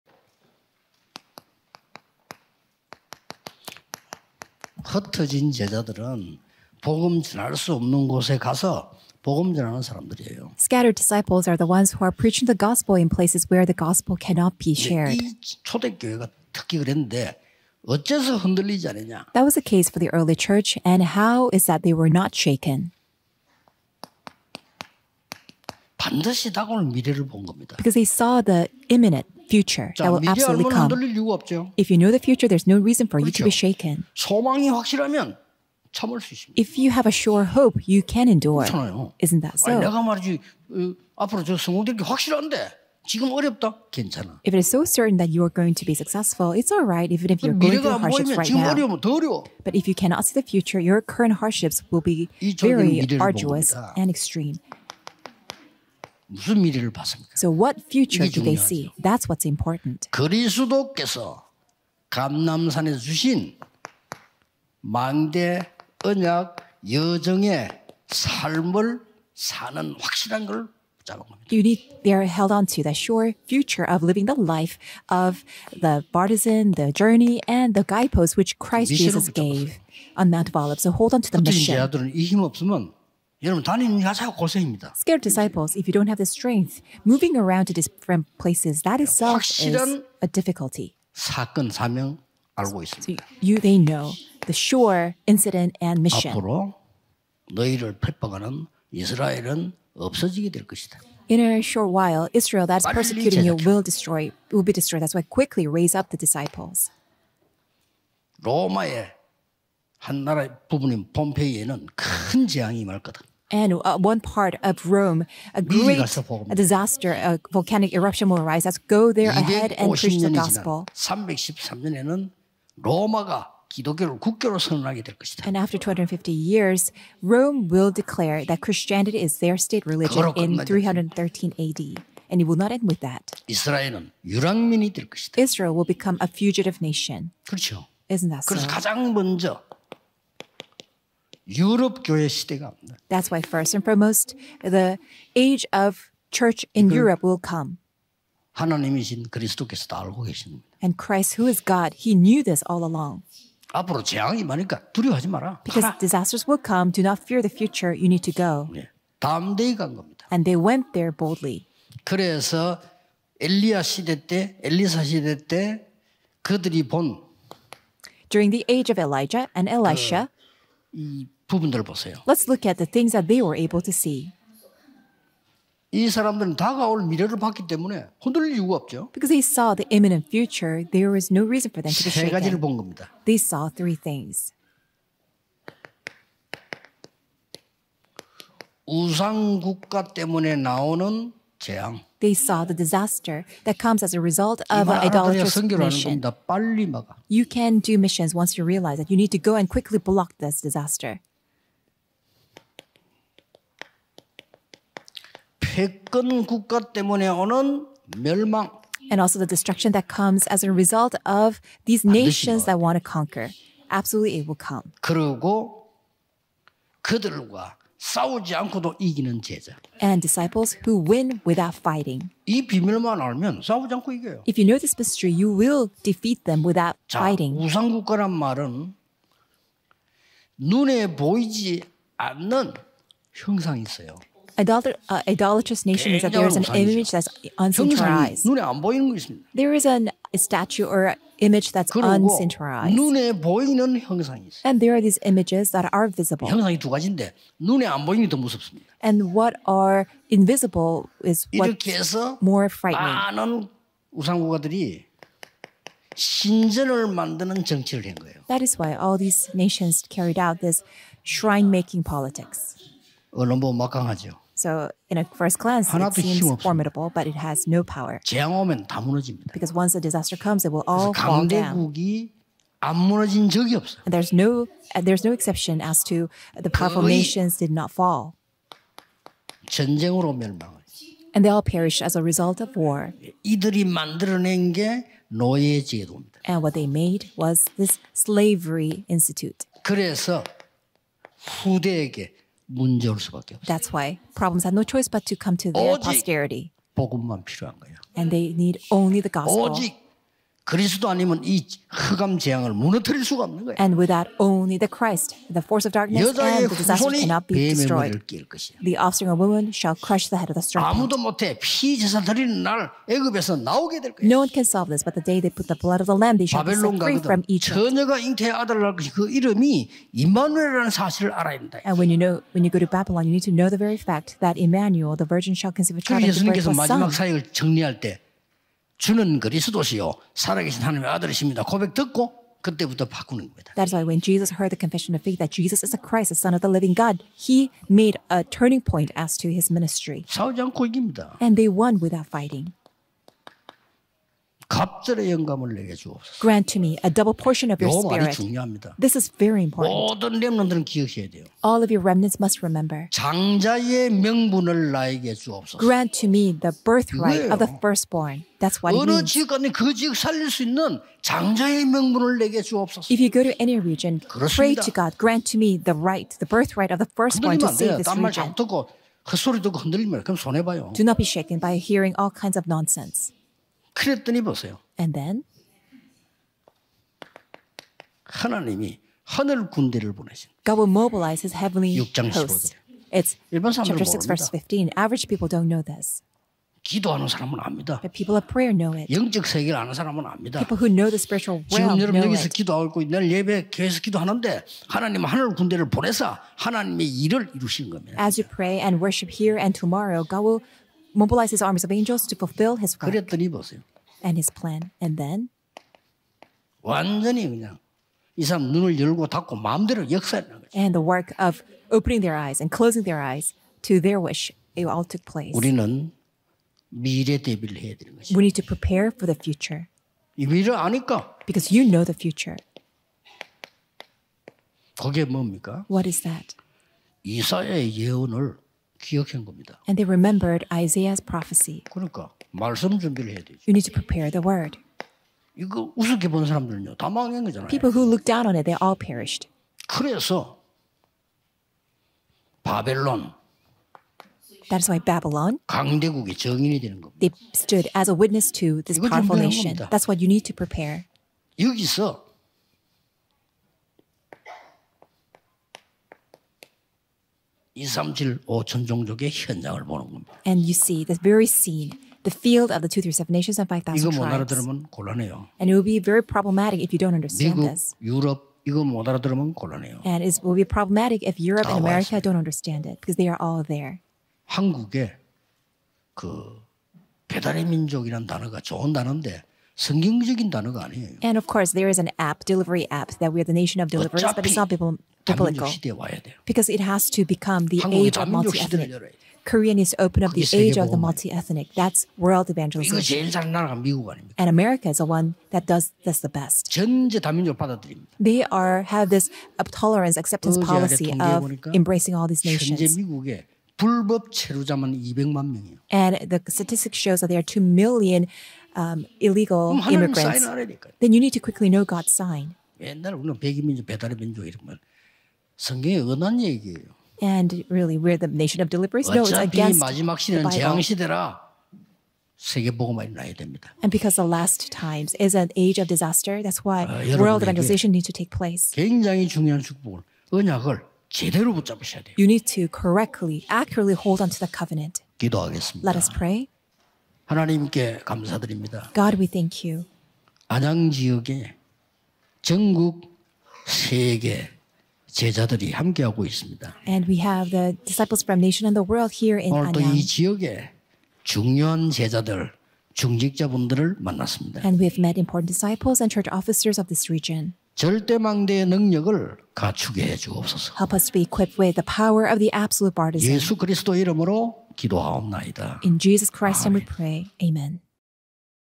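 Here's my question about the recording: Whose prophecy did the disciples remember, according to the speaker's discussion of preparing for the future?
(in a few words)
Isaiah.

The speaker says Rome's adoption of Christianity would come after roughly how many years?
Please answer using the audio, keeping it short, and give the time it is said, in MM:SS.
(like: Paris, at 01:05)
250 years, at 02:05.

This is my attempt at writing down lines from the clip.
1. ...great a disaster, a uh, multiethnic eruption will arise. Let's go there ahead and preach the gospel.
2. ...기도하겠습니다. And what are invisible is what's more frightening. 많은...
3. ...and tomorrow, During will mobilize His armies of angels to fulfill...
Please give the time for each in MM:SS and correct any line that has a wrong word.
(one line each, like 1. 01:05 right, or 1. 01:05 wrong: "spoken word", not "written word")
1. 01:55 wrong: "volcanic", not "multiethnic"
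2. 04:08 wrong: "무섭습니다", not "기도하겠습니다"
3. 06:39 wrong: "God", not "During".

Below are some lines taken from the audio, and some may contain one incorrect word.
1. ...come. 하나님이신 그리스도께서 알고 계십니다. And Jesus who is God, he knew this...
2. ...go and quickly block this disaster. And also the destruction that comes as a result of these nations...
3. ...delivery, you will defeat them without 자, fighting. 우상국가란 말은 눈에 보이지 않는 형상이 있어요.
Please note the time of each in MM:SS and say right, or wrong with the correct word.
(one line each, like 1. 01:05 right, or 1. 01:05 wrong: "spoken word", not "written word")
1. 02:27 wrong: "Christ", not "Jesus"
2. 03:19 right
3. 03:44 wrong: "mystery", not "delivery".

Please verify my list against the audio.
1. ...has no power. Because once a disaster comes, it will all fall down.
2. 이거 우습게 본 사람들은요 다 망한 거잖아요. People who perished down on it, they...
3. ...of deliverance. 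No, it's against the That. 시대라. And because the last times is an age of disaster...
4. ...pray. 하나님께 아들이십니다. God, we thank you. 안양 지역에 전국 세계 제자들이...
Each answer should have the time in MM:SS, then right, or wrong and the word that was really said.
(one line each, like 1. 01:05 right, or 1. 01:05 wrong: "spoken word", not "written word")
1. 04:27 right
2. 07:15 wrong: "looked", not "perished"
3. 08:38 wrong: "Bible", not "That"
4. 08:56 wrong: "감사드립니다", not "아들이십니다".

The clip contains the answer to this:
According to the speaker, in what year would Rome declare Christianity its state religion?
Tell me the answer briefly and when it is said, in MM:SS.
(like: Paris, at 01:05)
313 AD, at 02:10.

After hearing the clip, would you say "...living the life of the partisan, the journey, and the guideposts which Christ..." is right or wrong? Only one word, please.
right.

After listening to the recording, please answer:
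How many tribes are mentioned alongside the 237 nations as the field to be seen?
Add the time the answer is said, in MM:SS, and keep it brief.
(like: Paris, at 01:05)
5,000, at 07:43.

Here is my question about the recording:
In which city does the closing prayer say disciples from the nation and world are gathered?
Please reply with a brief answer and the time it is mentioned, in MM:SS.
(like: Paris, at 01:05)
Anyang, at 09:09.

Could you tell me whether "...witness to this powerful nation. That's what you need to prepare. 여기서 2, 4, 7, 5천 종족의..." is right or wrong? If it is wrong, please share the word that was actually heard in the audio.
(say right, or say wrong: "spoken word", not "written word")
wrong: "3", not "4".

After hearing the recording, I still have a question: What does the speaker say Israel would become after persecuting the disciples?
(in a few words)
a fugitive nation.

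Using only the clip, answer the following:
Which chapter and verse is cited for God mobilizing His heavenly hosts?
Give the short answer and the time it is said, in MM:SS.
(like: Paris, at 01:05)
Chapter 6, verse 15, at 06:23.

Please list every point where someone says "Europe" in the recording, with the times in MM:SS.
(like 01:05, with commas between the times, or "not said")
02:26, 07:51.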